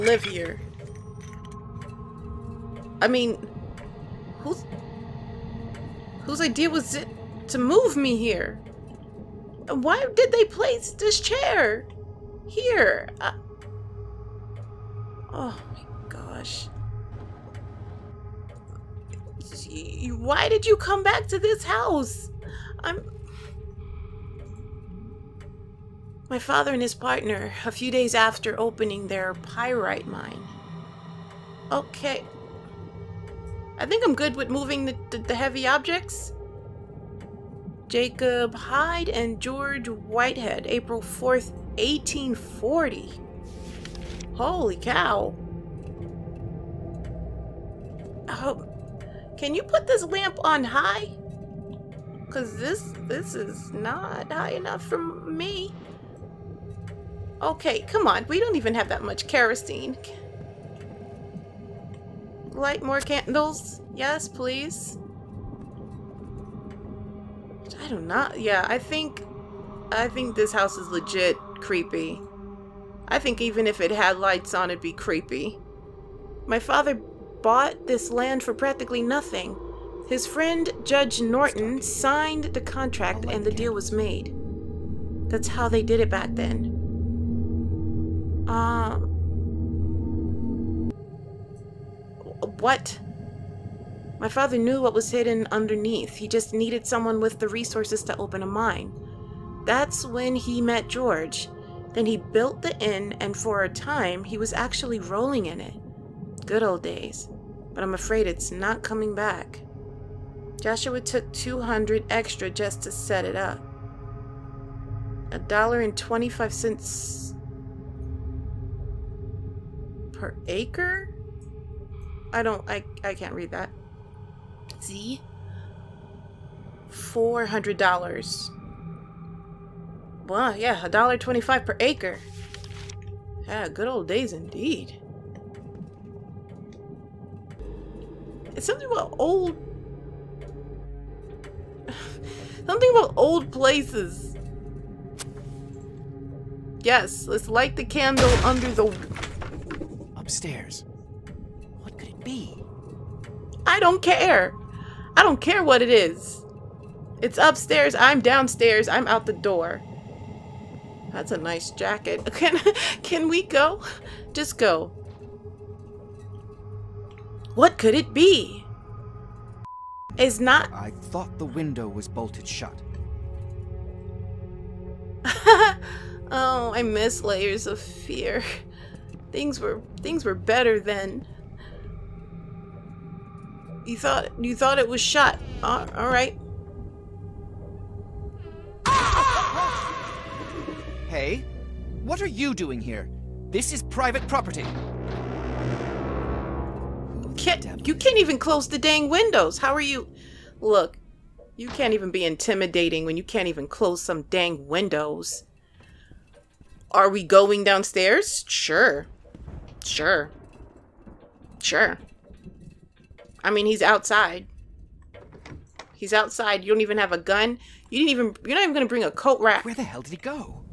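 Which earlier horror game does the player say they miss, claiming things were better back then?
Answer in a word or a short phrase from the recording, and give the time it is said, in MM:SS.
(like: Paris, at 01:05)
Layers of Fear, at 02:57.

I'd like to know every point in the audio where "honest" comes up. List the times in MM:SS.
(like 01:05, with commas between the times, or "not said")
not said.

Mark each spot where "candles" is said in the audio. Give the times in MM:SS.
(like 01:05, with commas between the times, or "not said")
01:02, 02:27.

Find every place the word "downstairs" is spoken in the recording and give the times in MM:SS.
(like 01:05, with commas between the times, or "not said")
02:38, 03:27.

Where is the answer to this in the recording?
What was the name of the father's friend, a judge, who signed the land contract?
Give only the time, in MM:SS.
01:20.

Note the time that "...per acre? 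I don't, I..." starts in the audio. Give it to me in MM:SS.
02:00.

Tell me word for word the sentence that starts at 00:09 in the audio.
Why did they place this chair here?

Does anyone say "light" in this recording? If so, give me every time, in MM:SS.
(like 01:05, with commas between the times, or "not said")
01:02, 01:14, 02:27.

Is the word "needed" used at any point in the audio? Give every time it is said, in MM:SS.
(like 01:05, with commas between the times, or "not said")
01:36.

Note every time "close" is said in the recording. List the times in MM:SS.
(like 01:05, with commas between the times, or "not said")
03:18, 03:23.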